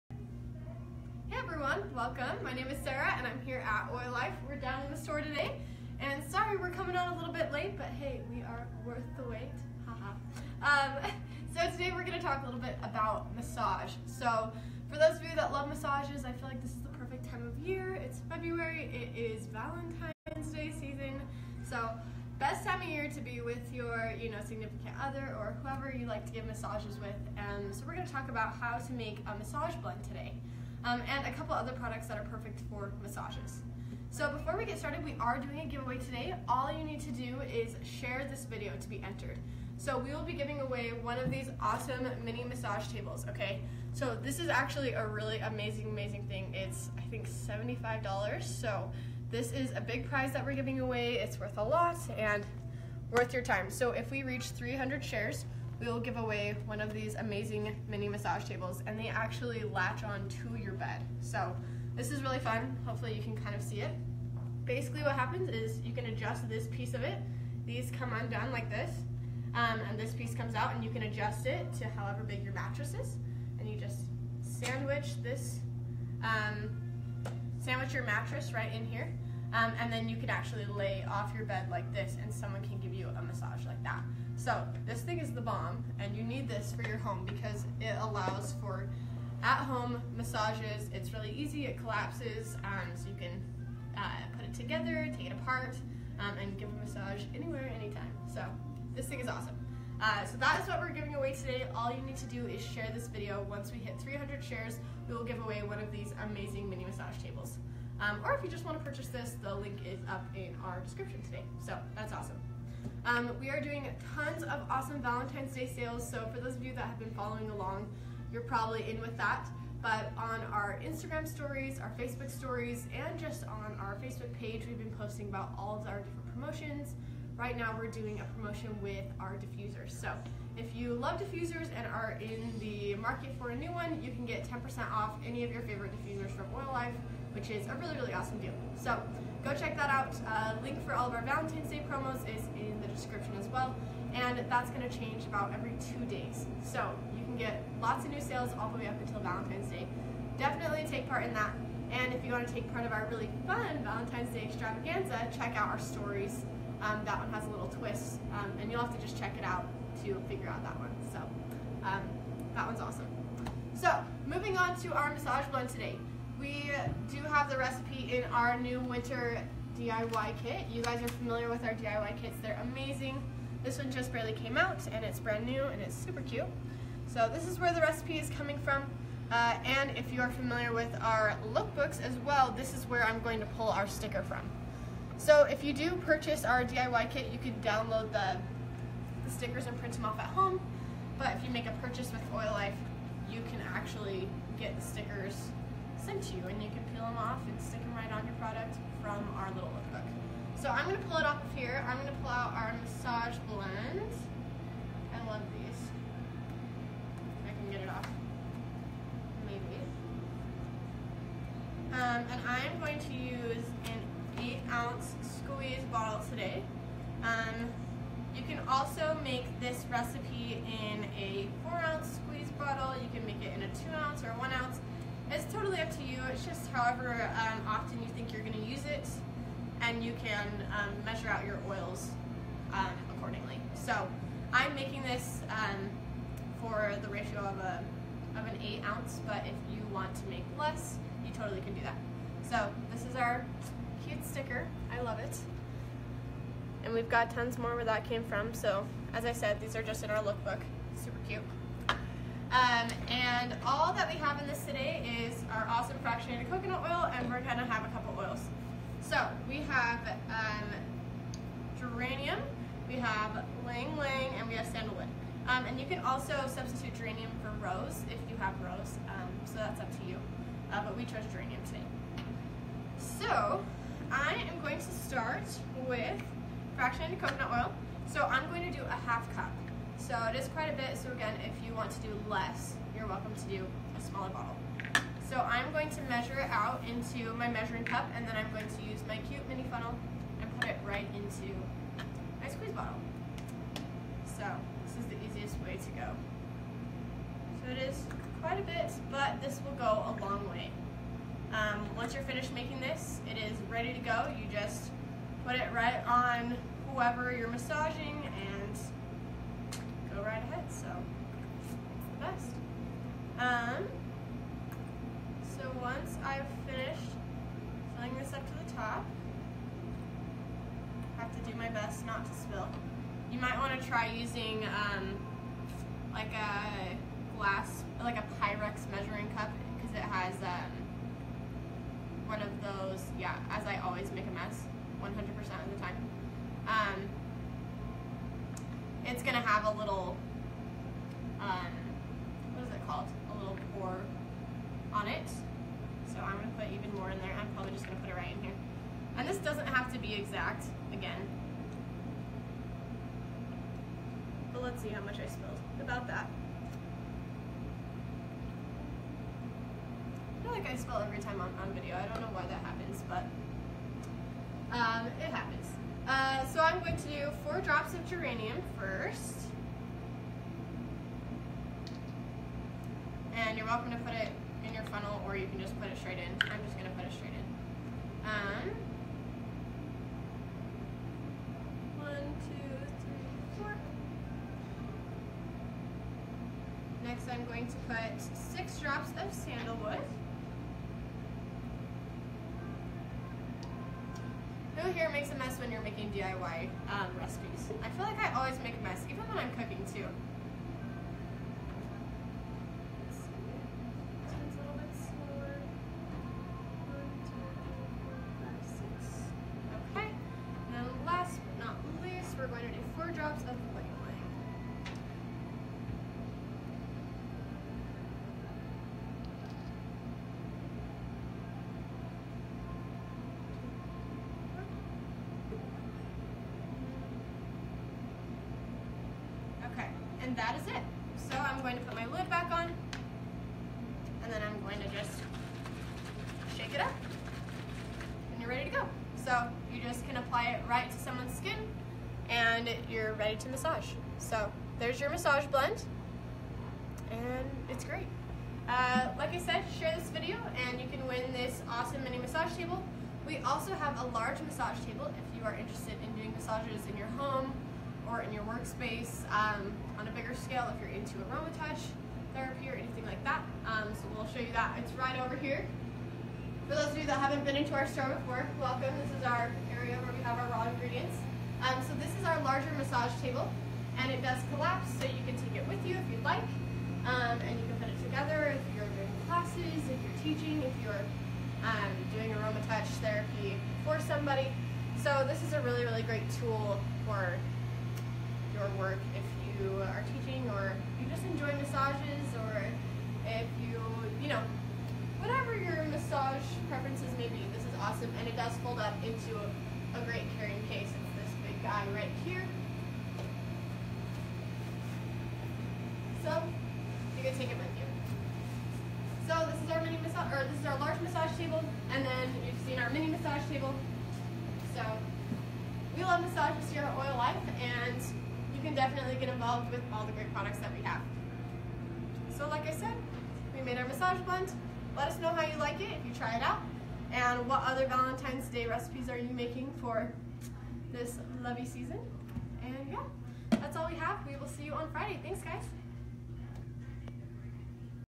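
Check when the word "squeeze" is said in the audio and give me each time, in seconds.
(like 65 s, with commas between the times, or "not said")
215 s, 222 s, 292 s.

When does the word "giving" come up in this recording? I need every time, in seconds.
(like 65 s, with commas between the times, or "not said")
40 s, 50 s, 100 s.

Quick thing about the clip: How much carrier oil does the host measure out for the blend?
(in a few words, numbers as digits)
half cup.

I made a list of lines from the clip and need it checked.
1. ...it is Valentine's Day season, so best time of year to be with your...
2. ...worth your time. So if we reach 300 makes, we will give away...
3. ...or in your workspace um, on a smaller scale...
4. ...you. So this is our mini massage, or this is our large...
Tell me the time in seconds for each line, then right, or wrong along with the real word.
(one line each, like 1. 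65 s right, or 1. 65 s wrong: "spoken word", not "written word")
1. 18 s right
2. 53 s wrong: "shares", not "makes"
3. 458 s wrong: "bigger", not "smaller"
4. 507 s right.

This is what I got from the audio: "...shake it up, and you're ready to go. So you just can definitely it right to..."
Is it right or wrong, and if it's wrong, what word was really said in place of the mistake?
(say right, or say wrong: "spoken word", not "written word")
wrong: "apply", not "definitely".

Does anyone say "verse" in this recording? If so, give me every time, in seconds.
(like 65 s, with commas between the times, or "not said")
not said.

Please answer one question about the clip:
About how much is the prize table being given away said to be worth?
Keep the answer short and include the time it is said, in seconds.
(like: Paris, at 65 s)
$75, at 47 s.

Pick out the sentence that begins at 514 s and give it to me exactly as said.
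So we love massages here at Oil Life, and you can definitely get involved with all the great products that we have.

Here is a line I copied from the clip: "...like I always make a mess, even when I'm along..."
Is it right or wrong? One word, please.
wrong.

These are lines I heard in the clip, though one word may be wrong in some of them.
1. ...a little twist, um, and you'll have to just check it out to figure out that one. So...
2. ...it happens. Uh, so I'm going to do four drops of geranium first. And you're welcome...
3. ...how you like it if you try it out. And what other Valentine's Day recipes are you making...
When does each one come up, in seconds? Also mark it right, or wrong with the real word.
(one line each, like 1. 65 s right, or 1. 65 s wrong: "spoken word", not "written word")
1. 157 s right
2. 365 s right
3. 525 s right.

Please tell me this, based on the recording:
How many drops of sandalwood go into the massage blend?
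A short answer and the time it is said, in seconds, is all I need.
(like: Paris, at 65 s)
6, at 388 s.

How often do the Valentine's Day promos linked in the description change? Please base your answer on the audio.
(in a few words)
every two days.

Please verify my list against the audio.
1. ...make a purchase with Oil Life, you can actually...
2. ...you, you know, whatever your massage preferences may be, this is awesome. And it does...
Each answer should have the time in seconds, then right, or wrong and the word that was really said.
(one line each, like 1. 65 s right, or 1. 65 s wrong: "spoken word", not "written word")
1. 191 s right
2. 493 s right.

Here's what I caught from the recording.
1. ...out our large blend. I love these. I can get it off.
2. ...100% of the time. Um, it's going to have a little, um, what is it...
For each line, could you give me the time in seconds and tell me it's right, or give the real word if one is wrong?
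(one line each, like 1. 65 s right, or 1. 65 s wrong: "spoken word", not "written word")
1. 202 s wrong: "massage", not "large"
2. 335 s right.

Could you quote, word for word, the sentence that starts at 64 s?
Basically what happens is you can adjust this piece of it.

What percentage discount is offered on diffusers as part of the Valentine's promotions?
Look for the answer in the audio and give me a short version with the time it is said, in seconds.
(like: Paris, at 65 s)
10%, at 134 s.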